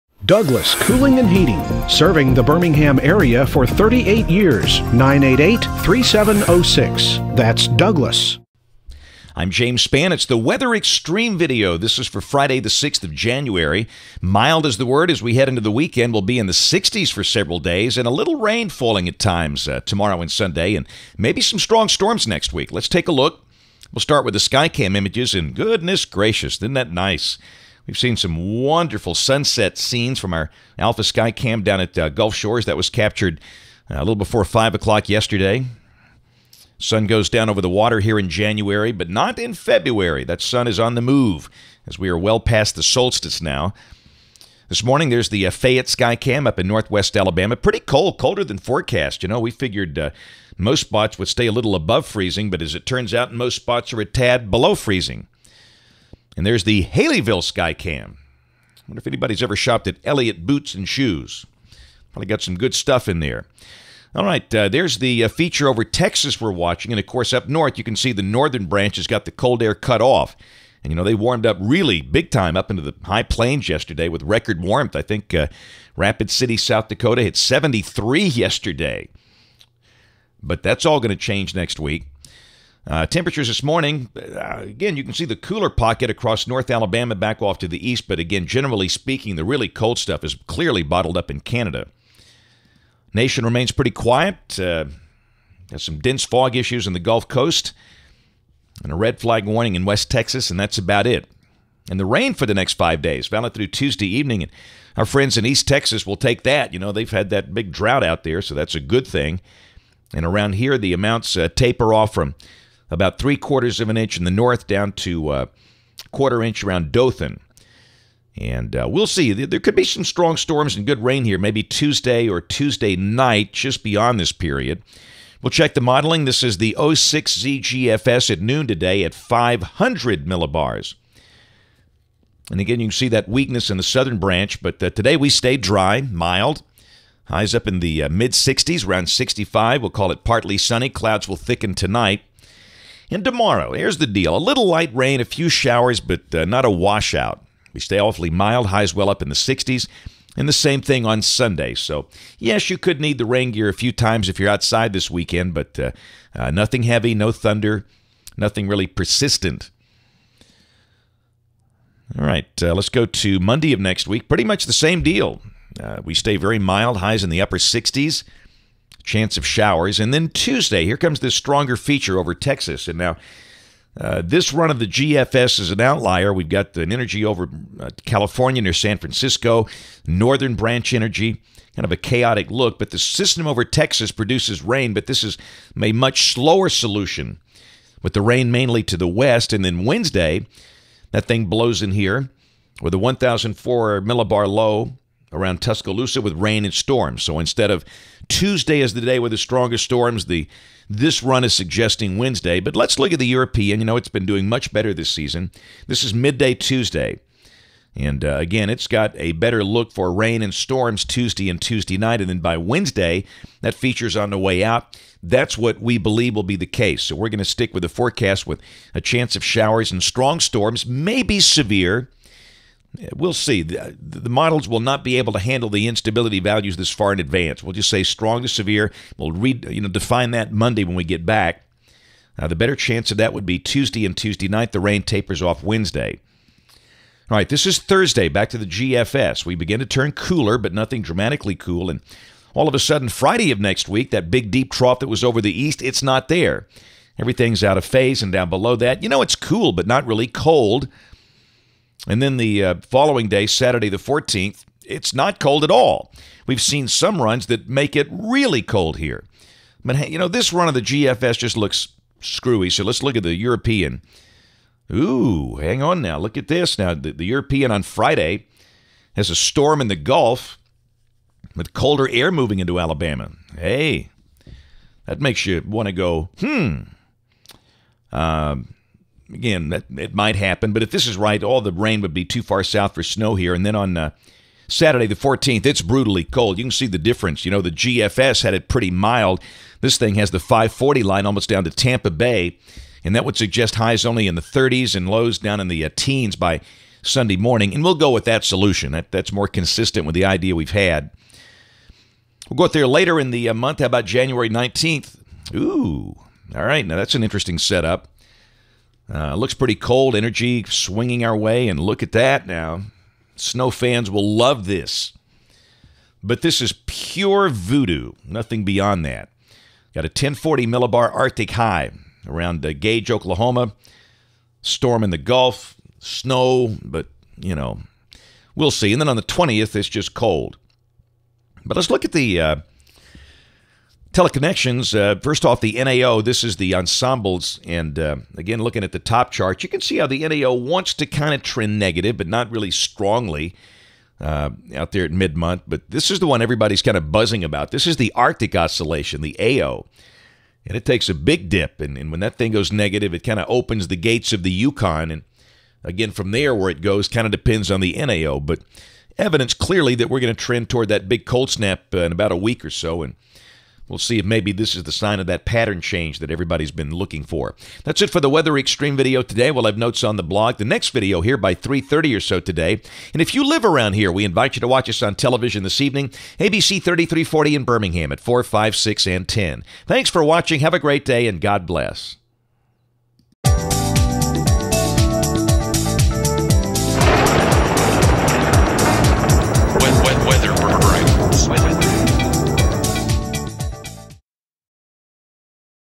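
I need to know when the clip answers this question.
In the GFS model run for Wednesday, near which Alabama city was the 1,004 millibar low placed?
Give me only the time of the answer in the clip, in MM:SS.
03:15.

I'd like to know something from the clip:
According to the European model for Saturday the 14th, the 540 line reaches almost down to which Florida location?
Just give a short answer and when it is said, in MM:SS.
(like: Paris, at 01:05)
Tampa Bay, at 04:51.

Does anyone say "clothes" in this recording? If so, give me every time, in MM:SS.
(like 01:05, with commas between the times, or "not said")
not said.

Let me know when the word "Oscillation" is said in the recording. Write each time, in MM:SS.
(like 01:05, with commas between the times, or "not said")
05:48.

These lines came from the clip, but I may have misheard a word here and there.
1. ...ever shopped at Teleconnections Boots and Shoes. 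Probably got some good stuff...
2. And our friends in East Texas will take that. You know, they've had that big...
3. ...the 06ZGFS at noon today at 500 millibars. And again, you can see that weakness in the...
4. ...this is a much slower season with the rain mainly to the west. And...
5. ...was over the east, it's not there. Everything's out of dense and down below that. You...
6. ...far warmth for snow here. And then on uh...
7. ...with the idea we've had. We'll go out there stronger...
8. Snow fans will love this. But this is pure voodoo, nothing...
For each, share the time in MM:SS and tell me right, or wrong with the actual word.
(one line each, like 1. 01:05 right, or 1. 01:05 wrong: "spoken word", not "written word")
1. 00:59 wrong: "Elliott", not "Teleconnections"
2. 01:44 right
3. 02:06 right
4. 03:05 wrong: "solution", not "season"
5. 04:05 wrong: "phase", not "dense"
6. 04:42 wrong: "south", not "warmth"
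7. 05:00 wrong: "later", not "stronger"
8. 05:13 right.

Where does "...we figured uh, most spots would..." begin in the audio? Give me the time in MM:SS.
00:49.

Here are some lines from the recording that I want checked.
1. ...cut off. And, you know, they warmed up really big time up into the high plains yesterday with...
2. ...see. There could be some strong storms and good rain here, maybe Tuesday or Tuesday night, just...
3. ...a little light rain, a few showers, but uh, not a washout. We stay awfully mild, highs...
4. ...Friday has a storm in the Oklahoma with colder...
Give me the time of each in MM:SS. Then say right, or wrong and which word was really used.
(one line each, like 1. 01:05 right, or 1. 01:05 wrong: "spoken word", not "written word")
1. 01:09 right
2. 01:59 right
3. 02:24 right
4. 04:27 wrong: "Gulf", not "Oklahoma".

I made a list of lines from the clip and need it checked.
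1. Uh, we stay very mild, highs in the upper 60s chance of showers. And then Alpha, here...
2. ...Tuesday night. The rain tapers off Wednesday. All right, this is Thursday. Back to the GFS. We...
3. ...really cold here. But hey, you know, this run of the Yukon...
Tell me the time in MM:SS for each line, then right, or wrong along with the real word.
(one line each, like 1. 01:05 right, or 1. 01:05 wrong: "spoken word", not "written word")
1. 02:45 wrong: "Tuesday", not "Alpha"
2. 03:54 right
3. 04:18 wrong: "GFS", not "Yukon".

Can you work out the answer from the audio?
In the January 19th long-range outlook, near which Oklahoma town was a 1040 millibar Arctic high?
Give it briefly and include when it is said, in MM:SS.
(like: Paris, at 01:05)
Gage, at 05:22.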